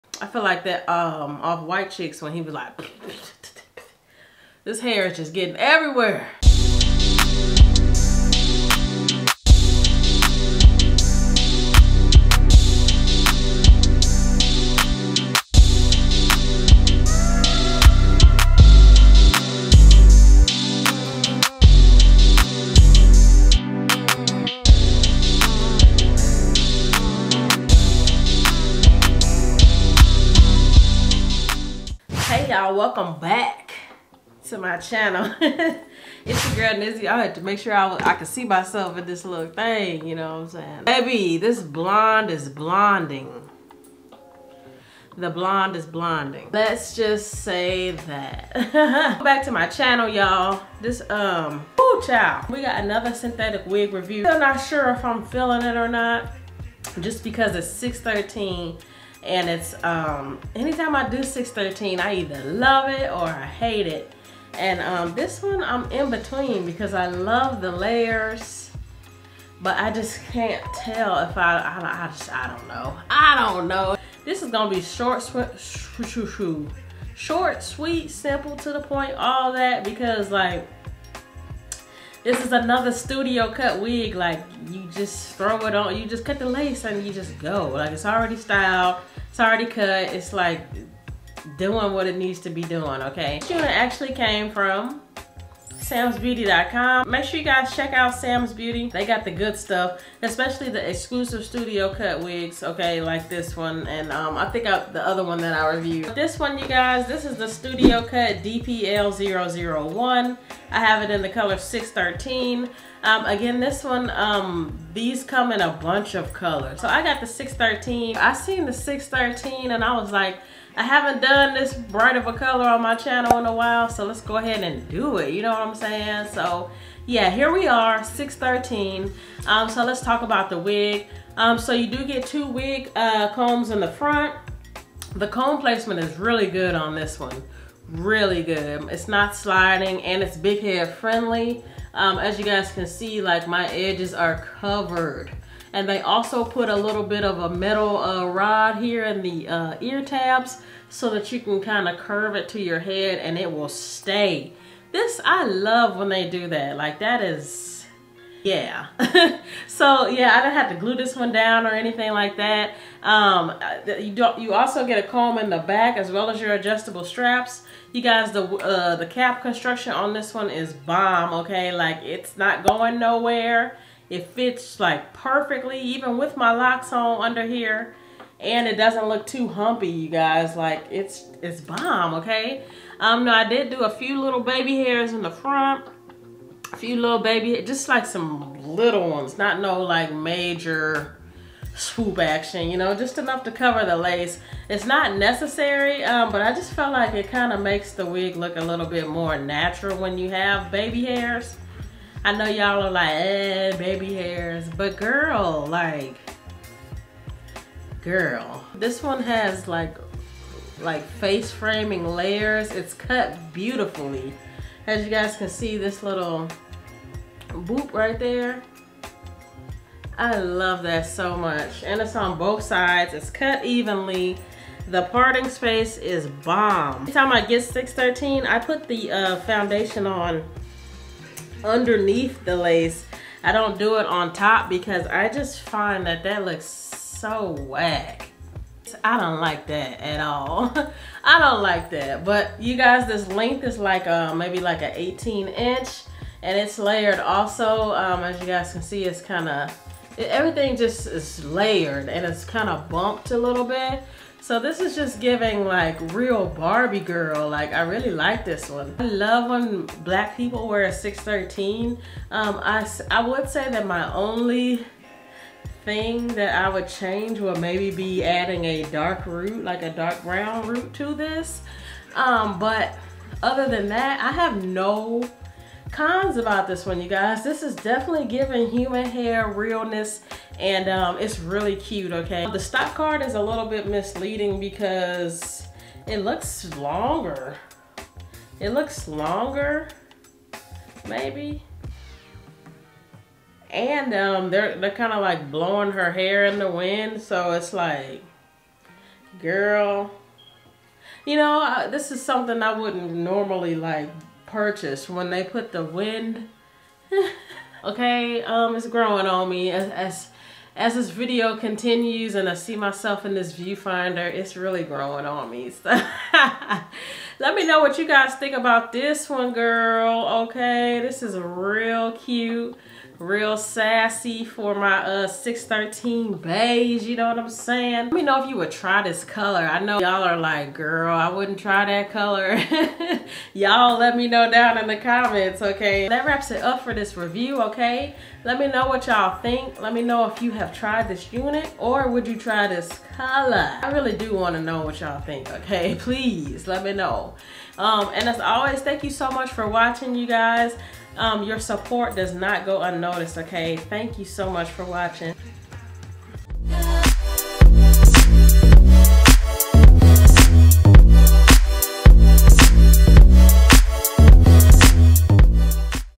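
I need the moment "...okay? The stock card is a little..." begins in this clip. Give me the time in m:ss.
4:42.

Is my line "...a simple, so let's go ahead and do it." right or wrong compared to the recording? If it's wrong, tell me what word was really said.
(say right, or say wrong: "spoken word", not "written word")
wrong: "while", not "simple".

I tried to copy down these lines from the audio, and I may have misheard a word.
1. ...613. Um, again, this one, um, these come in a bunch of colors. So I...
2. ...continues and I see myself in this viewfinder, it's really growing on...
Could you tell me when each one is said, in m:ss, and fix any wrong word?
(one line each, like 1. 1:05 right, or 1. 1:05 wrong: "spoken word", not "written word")
1. 1:51 right
2. 5:11 right.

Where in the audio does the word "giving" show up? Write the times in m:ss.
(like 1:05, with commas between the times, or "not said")
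4:15, 4:38.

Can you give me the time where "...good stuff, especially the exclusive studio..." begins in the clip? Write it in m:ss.
1:39.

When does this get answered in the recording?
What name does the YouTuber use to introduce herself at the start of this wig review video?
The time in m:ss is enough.
0:36.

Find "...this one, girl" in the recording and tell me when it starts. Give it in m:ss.
5:18.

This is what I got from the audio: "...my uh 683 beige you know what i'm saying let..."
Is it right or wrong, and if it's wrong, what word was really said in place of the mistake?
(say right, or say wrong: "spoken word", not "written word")
wrong: "613", not "683".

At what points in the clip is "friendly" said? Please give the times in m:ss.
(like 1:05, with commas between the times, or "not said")
2:20.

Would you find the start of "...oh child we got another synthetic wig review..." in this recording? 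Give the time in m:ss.
0:51.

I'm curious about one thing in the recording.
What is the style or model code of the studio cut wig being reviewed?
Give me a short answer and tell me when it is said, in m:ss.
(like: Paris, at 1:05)
DPL001, at 1:48.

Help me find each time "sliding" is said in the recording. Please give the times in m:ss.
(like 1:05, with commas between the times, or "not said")
2:19.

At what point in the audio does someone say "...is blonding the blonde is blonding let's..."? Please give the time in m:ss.
0:42.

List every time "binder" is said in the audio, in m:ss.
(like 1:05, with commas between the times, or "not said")
not said.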